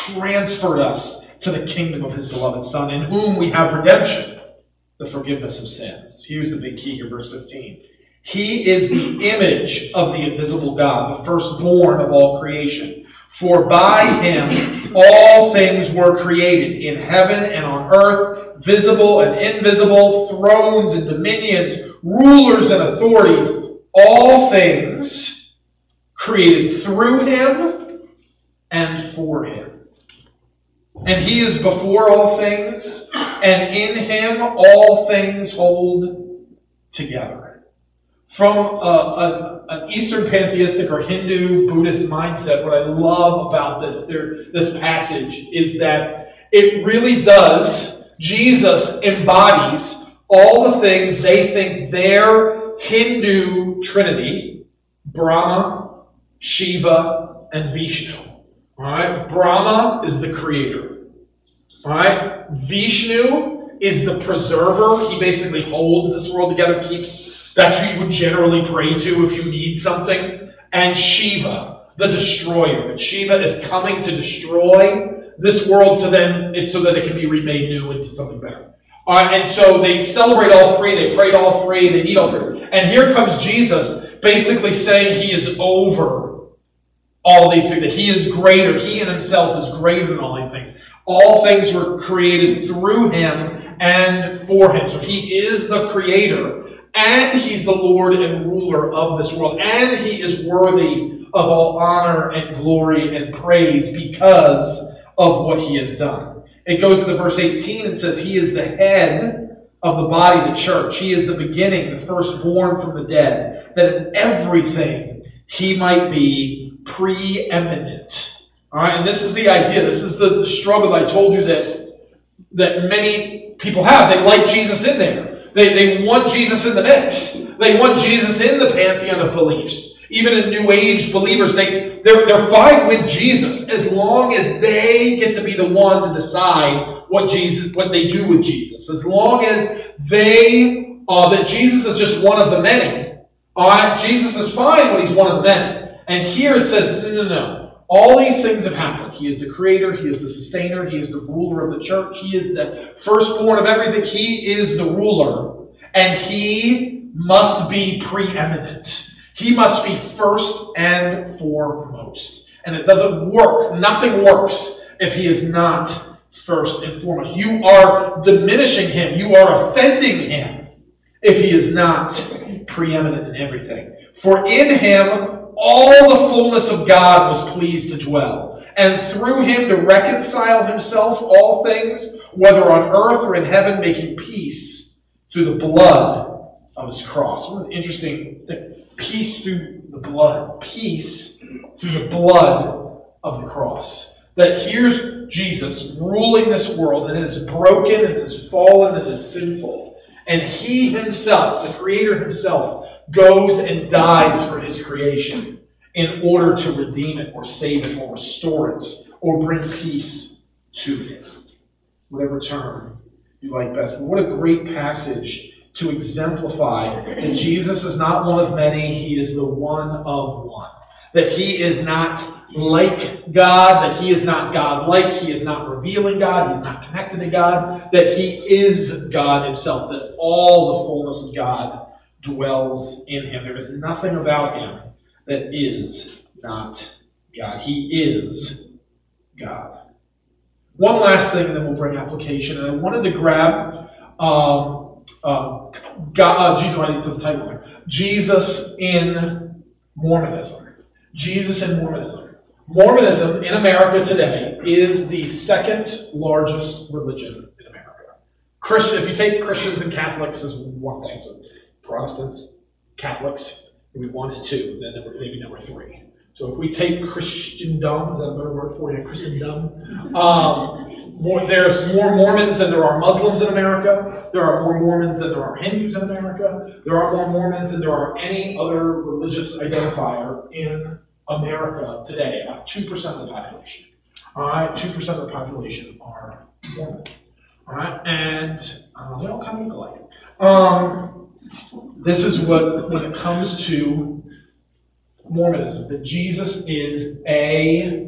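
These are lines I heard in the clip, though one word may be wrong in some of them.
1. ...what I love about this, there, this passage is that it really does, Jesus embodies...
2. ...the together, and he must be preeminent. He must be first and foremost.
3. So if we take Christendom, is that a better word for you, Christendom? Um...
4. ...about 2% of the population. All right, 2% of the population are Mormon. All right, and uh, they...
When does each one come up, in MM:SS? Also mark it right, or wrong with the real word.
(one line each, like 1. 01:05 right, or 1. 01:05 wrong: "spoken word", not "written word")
1. 00:42 right
2. 02:34 wrong: "ruler", not "together"
3. 04:26 right
4. 04:42 right.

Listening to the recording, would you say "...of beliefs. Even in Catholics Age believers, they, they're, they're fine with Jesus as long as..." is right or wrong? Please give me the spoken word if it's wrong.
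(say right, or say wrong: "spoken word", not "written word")
wrong: "New", not "Catholics".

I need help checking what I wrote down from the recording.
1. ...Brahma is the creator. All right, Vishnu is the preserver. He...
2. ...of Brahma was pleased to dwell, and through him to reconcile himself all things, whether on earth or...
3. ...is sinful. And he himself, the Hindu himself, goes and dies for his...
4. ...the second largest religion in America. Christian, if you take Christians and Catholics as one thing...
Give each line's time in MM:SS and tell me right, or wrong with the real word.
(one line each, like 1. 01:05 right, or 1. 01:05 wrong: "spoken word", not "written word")
1. 00:59 right
2. 02:56 wrong: "God", not "Brahma"
3. 03:19 wrong: "Creator", not "Hindu"
4. 04:15 right.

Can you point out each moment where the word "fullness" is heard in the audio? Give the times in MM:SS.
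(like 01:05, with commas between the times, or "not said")
02:56, 03:51.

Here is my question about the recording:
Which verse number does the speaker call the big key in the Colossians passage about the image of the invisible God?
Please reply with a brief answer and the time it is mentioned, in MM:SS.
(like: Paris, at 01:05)
15, at 00:07.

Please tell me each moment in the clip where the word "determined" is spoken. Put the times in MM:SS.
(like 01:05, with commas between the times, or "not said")
not said.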